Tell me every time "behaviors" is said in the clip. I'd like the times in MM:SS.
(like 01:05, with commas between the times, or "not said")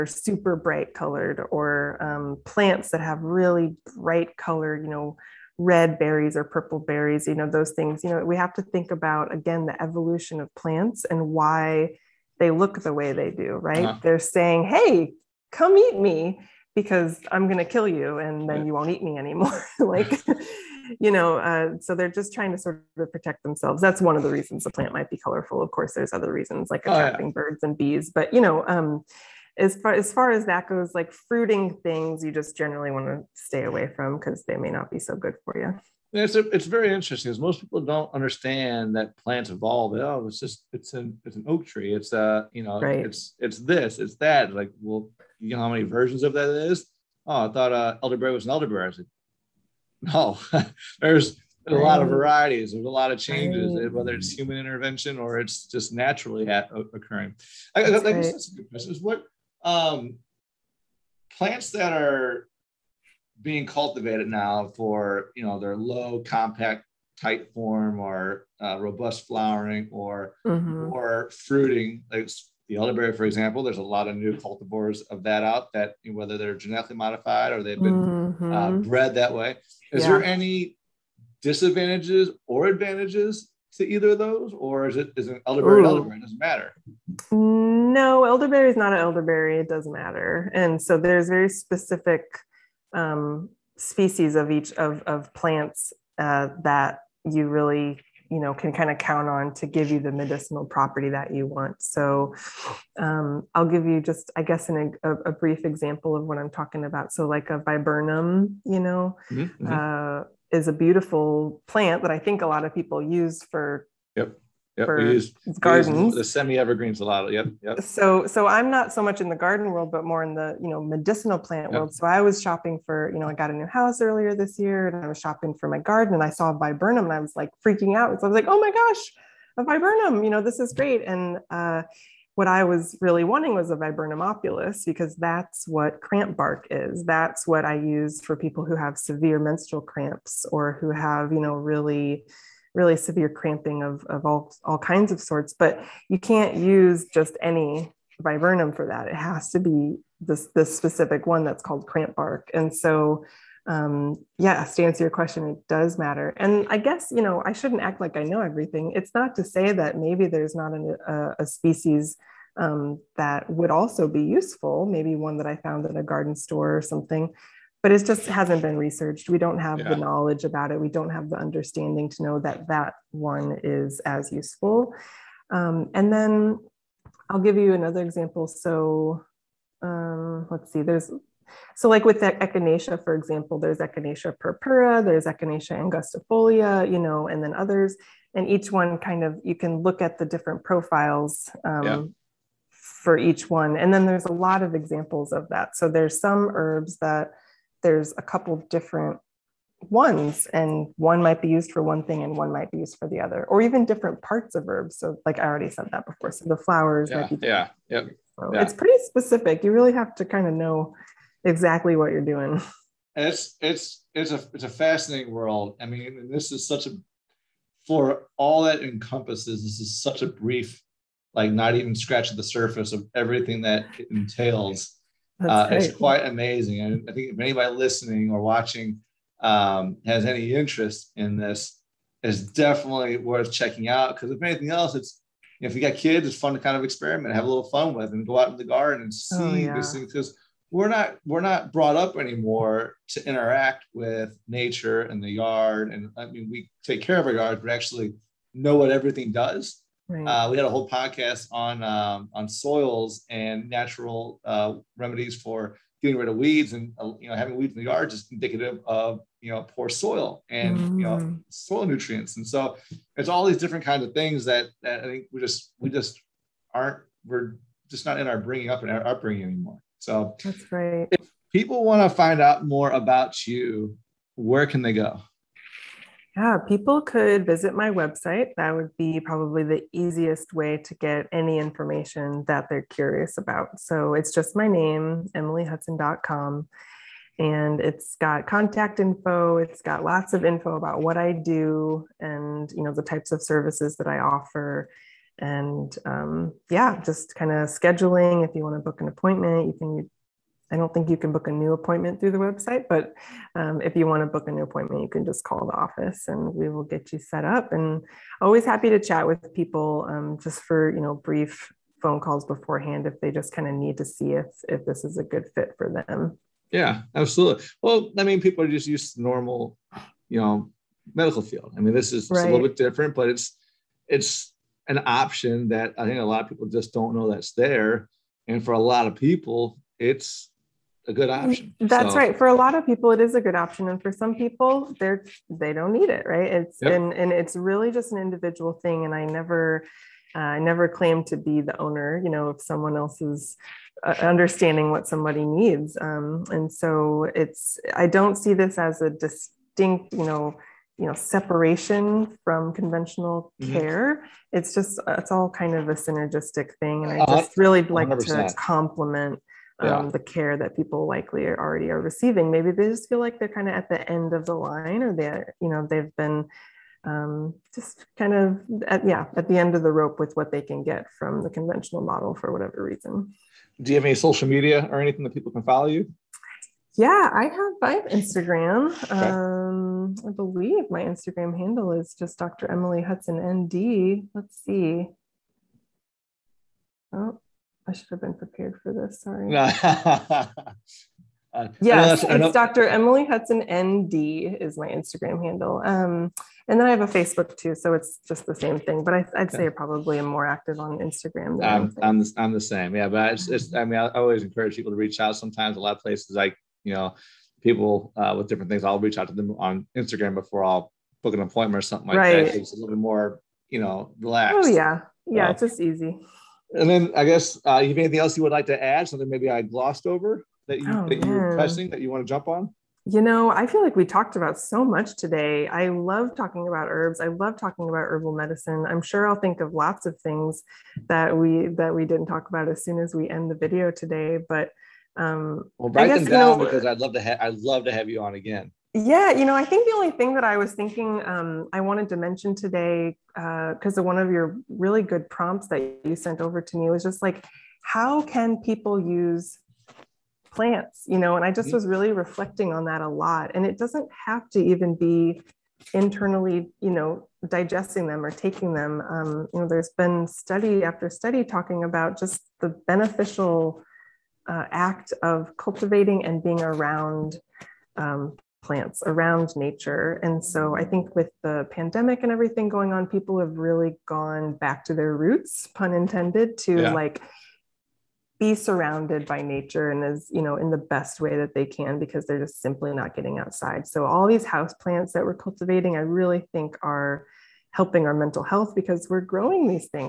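not said.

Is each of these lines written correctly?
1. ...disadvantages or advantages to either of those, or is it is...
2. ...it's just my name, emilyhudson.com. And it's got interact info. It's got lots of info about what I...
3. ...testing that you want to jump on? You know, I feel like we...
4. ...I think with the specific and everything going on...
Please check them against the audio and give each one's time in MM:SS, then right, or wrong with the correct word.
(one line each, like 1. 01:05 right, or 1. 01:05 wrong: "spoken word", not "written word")
1. 01:21 right
2. 04:44 wrong: "contact", not "interact"
3. 07:01 right
4. 07:50 wrong: "pandemic", not "specific".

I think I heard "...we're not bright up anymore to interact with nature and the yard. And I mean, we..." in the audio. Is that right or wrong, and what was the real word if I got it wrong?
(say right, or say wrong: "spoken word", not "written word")
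wrong: "brought", not "bright".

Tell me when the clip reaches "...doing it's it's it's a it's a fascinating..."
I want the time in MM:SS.
03:32.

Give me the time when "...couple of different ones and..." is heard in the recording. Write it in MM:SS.
03:18.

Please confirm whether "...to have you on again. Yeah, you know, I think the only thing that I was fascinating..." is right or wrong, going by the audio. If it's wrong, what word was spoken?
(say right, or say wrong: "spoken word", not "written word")
wrong: "thinking", not "fascinating".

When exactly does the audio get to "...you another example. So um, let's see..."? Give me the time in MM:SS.
02:57.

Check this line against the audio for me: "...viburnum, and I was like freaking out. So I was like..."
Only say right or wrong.
right.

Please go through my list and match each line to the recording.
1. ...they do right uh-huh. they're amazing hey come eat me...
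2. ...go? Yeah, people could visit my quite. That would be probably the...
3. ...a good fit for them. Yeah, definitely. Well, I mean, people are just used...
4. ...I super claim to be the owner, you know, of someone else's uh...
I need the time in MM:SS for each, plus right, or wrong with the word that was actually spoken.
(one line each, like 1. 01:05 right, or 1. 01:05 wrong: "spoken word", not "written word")
1. 00:13 wrong: "saying", not "amazing"
2. 04:34 wrong: "website", not "quite"
3. 05:15 wrong: "absolutely", not "definitely"
4. 05:40 wrong: "never", not "super".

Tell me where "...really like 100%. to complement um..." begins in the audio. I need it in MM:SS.
05:57.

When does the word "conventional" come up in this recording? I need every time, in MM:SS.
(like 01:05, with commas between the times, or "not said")
05:52, 06:11.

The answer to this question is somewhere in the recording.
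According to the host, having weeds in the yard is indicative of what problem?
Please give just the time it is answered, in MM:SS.
04:19.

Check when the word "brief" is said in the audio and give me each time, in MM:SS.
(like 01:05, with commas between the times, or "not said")
01:45, 03:40, 05:11.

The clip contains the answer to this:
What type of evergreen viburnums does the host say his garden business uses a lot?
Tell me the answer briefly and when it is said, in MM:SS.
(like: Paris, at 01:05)
Semi-evergreens, at 01:56.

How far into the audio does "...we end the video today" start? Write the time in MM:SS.
07:13.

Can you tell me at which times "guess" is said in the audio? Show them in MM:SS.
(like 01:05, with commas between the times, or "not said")
01:44, 02:36, 06:57.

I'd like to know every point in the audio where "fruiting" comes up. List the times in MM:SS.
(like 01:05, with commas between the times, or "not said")
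00:31, 01:11.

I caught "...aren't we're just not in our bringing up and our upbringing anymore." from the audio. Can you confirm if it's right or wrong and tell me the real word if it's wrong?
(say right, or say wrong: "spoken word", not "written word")
right.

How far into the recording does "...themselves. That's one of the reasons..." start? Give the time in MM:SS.
00:23.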